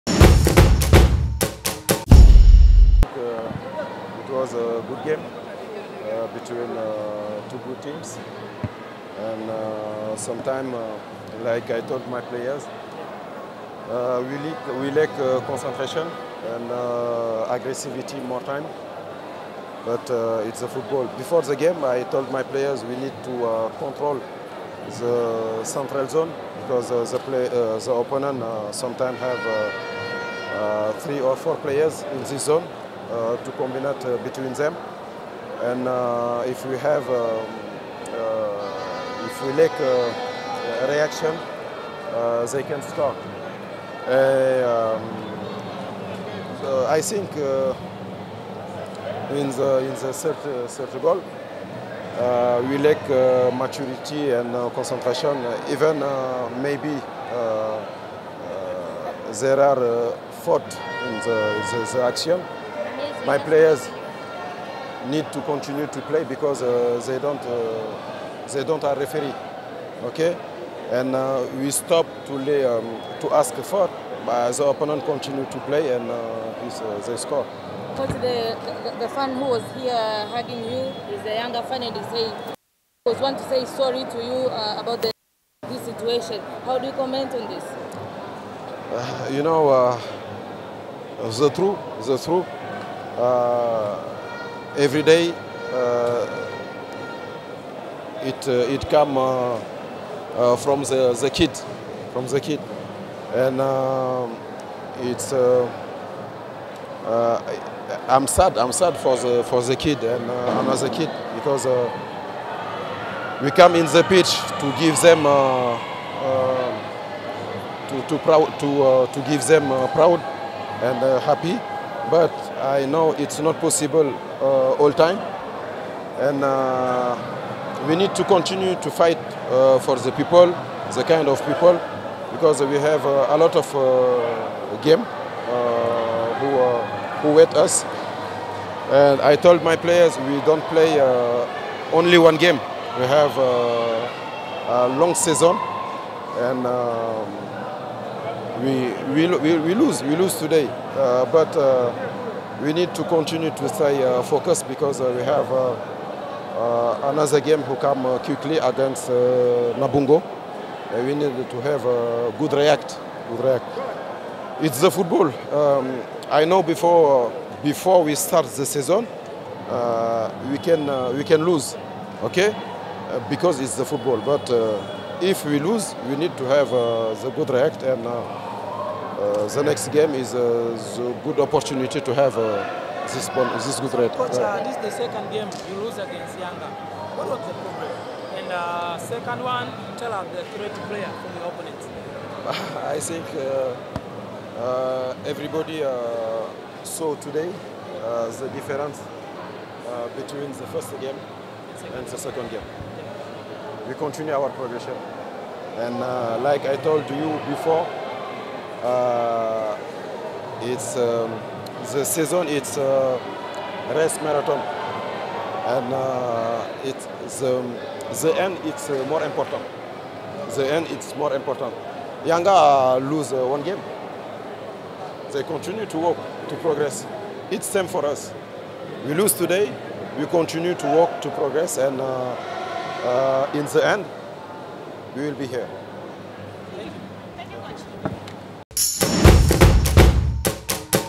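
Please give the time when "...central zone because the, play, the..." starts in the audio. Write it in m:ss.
0:25.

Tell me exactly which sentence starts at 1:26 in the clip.
How do you comment on this?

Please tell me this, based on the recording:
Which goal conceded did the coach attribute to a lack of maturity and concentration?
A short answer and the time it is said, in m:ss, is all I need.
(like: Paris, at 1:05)
Third goal, at 0:50.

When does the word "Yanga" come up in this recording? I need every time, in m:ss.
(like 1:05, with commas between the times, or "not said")
3:06, 3:42.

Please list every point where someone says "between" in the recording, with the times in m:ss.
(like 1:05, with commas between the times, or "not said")
0:06, 0:34, 3:20.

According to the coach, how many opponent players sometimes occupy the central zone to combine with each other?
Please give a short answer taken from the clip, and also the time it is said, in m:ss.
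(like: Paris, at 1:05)
3 or 4, at 0:31.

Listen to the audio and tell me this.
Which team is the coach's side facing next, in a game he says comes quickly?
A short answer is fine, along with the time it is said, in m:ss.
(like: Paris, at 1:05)
Namungo, at 2:39.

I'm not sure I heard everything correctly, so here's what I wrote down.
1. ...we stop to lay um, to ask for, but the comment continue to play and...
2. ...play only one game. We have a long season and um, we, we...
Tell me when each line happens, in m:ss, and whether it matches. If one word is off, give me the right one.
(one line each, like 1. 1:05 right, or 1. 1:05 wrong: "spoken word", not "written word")
1. 1:11 wrong: "opponent", not "comment"
2. 2:20 right.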